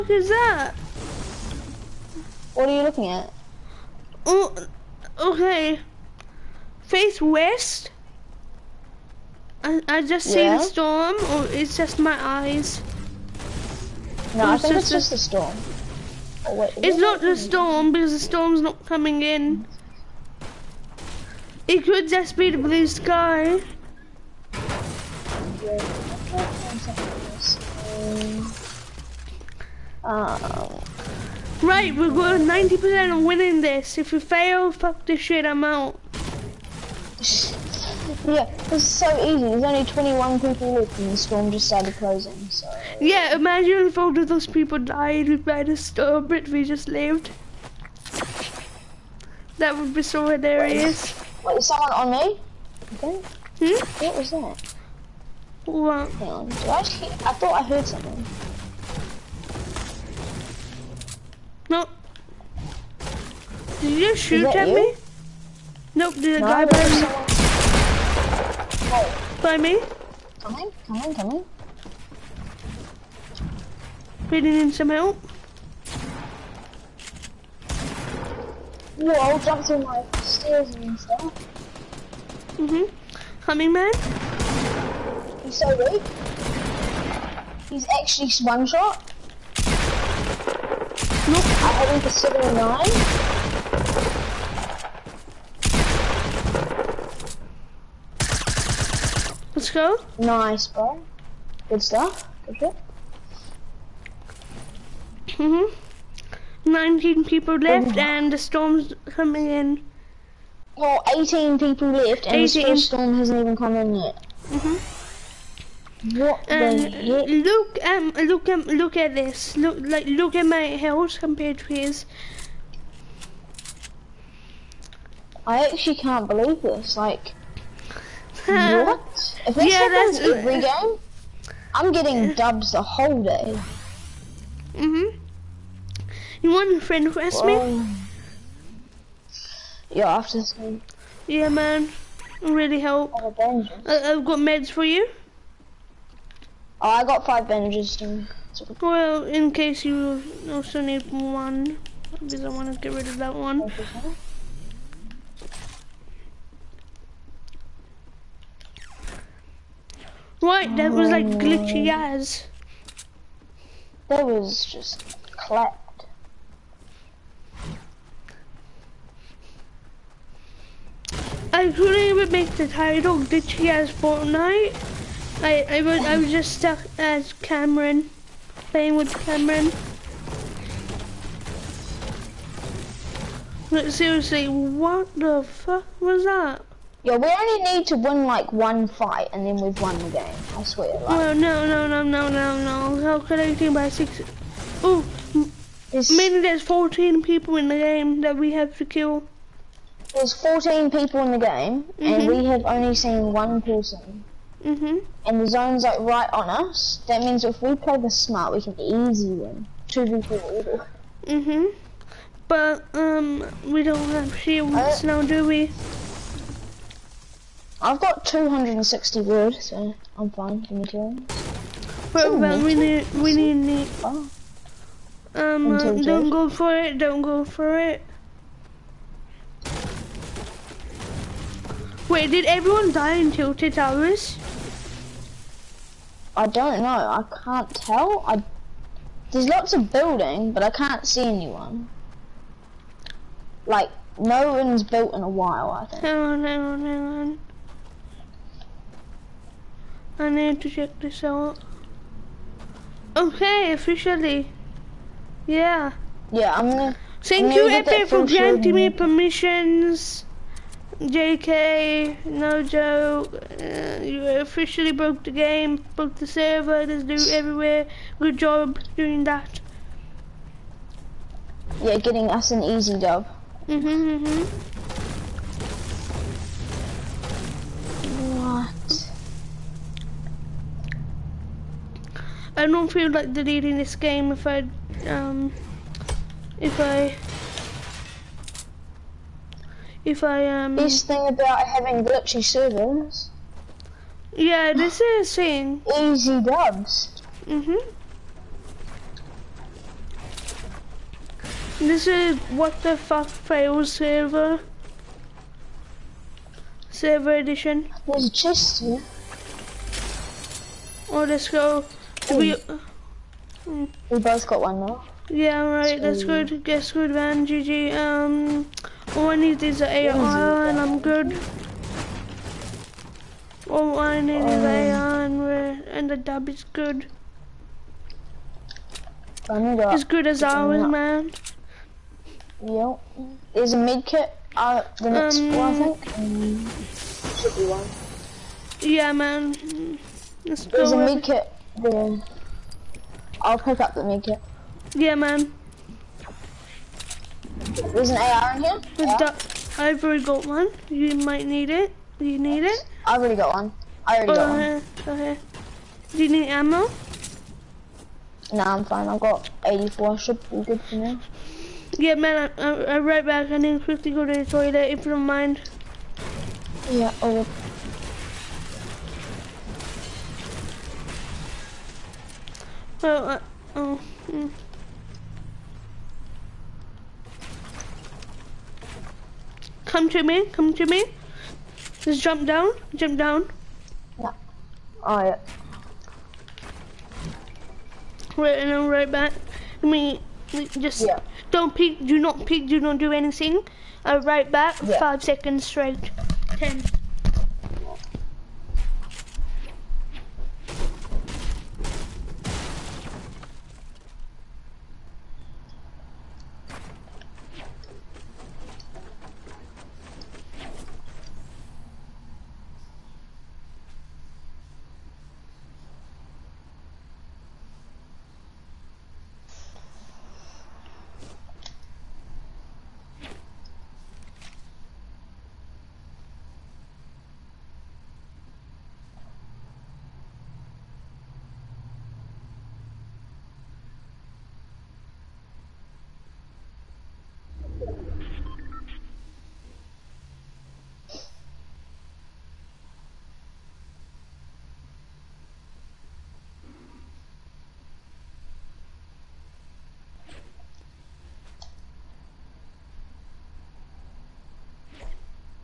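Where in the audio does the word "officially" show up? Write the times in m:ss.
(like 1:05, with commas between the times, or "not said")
4:13, 4:24.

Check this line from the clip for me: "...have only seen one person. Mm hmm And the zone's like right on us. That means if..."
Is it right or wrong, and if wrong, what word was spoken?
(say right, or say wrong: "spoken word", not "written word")
right.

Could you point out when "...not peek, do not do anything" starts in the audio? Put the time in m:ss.
6:32.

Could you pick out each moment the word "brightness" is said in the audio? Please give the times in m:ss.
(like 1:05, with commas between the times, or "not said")
not said.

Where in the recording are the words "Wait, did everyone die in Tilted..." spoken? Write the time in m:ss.
3:52.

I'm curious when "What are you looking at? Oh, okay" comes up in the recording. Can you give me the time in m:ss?
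0:02.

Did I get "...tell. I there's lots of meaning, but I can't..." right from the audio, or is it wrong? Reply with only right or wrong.
wrong.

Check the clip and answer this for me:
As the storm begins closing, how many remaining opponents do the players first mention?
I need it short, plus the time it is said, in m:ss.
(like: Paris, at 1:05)
21, at 0:39.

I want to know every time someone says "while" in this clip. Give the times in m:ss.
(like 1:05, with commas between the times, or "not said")
4:05.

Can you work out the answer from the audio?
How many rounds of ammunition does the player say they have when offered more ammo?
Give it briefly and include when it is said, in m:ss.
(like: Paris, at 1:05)
84, at 5:59.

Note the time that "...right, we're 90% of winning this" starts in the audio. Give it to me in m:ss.
0:31.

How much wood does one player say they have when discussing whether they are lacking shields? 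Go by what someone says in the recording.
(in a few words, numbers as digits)
260.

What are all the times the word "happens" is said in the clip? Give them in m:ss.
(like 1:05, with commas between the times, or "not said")
2:09.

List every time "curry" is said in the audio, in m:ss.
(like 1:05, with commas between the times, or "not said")
not said.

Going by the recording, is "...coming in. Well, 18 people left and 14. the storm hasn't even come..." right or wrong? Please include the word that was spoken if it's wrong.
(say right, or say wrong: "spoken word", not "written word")
wrong: "18", not "14".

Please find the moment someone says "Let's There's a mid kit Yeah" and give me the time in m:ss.
5:40.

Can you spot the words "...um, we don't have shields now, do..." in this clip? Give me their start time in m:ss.
3:33.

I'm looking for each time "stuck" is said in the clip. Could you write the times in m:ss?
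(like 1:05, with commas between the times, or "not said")
2:56.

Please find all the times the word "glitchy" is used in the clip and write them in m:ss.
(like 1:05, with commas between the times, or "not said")
2:41, 4:52.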